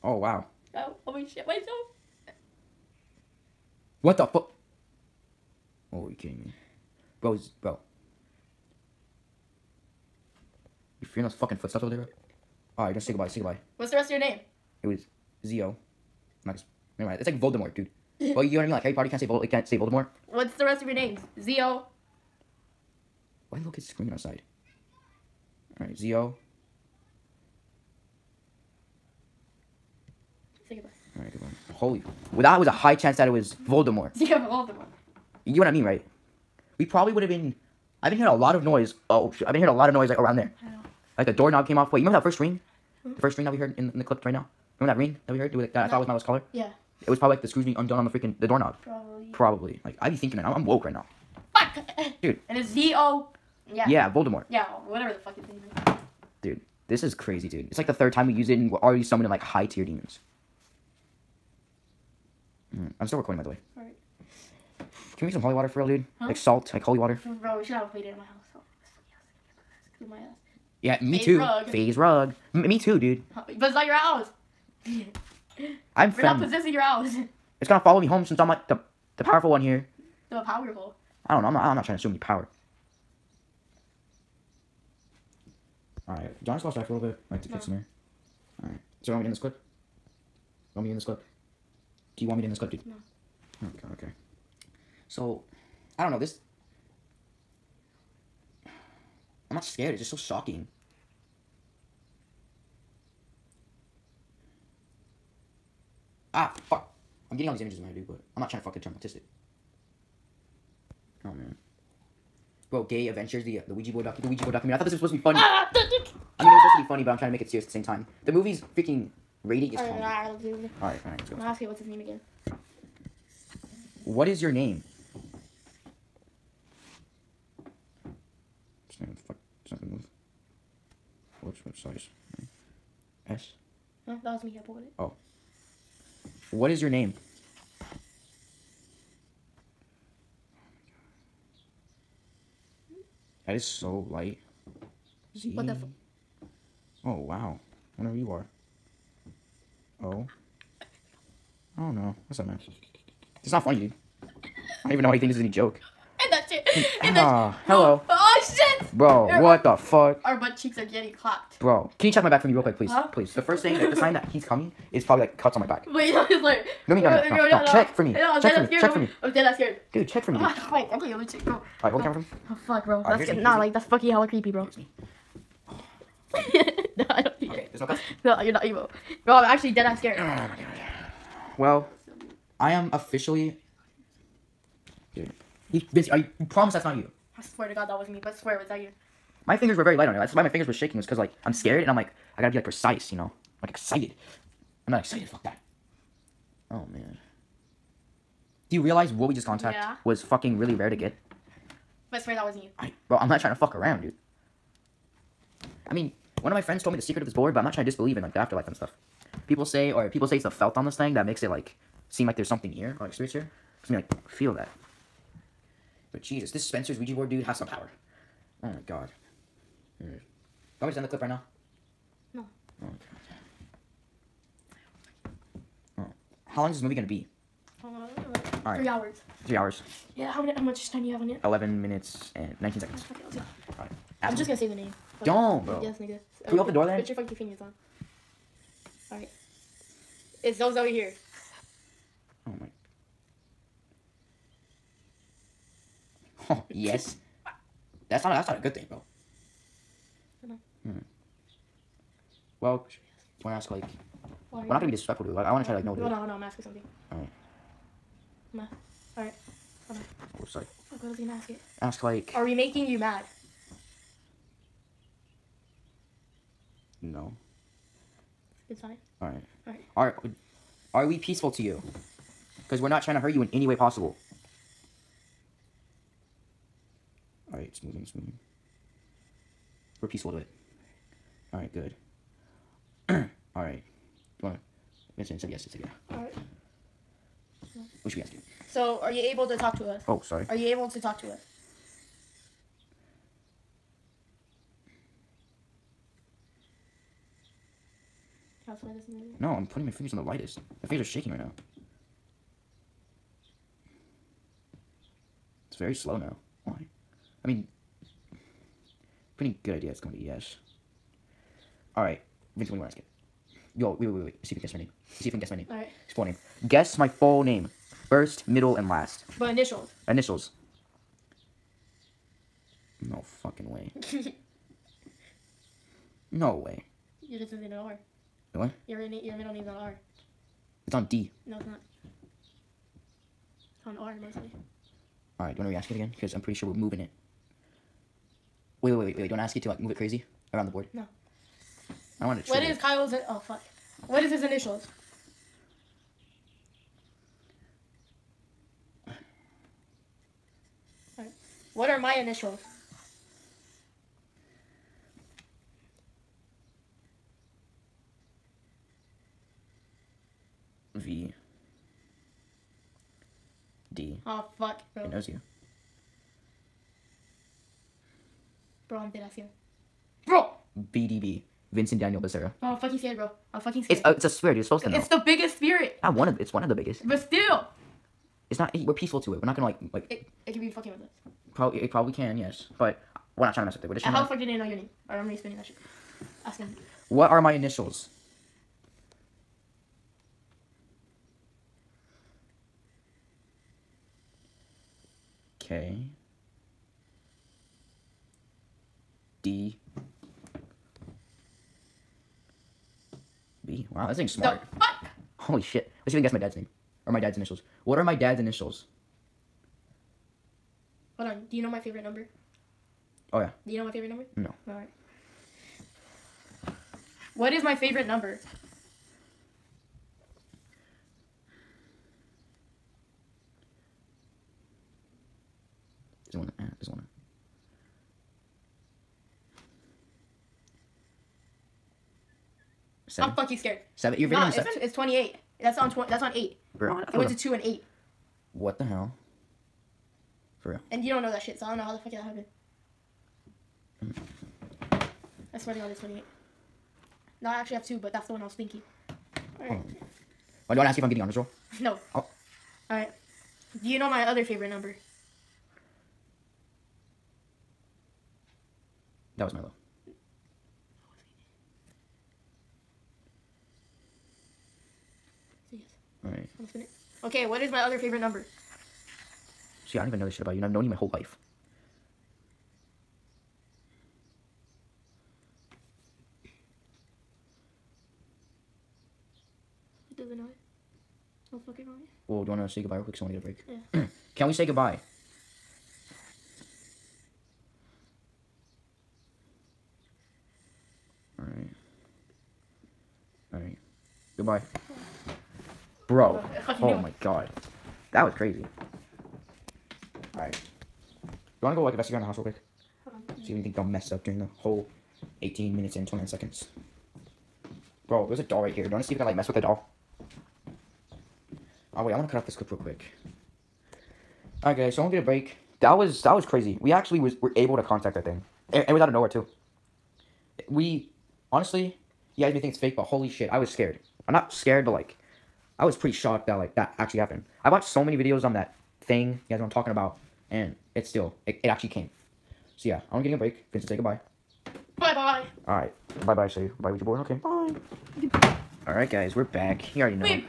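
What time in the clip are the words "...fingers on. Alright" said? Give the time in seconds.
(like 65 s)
237 s.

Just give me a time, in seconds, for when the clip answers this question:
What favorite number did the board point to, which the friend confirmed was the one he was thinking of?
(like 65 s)
445 s.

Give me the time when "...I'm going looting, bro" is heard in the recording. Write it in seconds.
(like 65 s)
170 s.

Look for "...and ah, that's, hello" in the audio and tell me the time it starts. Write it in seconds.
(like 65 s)
157 s.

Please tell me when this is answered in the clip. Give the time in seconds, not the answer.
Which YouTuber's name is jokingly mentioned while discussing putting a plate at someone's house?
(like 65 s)
71 s.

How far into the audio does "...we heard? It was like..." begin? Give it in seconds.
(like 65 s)
45 s.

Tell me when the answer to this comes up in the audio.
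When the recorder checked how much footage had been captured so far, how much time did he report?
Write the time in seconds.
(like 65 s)
231 s.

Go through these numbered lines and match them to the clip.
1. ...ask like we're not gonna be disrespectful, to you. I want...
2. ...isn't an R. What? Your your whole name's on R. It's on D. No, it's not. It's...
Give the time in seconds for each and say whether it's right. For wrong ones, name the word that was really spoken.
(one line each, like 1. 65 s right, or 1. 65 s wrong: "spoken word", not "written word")
1. 253 s right
2. 327 s wrong: "middle", not "whole".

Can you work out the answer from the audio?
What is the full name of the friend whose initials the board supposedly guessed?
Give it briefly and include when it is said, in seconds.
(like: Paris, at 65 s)
Vincent Daniel Becerra, at 371 s.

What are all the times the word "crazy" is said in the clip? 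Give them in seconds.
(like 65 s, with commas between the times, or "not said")
57 s, 339 s, 498 s, 516 s.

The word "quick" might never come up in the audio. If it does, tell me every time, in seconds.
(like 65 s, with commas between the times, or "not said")
162 s, 483 s, 502 s, 512 s.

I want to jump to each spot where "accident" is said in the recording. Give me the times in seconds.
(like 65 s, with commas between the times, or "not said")
not said.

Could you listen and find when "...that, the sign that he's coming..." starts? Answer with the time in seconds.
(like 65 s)
163 s.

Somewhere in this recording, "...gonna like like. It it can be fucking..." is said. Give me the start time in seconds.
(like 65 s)
379 s.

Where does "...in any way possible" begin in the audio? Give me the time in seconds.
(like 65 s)
273 s.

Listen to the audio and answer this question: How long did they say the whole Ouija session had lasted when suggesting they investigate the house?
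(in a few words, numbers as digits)
18 minutes 29 seconds.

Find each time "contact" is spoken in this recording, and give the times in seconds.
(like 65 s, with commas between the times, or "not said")
199 s, 517 s.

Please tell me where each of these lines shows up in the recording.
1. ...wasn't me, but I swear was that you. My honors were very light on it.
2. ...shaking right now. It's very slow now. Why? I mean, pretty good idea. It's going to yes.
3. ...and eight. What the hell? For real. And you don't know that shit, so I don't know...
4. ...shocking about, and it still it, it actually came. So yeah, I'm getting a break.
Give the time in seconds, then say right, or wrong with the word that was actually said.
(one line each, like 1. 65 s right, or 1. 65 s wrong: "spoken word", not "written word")
1. 187 s wrong: "fingers", not "honors"
2. 301 s right
3. 437 s right
4. 529 s wrong: "talking", not "shocking".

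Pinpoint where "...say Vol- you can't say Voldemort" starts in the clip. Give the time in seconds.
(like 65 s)
19 s.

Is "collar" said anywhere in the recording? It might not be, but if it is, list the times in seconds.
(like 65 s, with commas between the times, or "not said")
46 s.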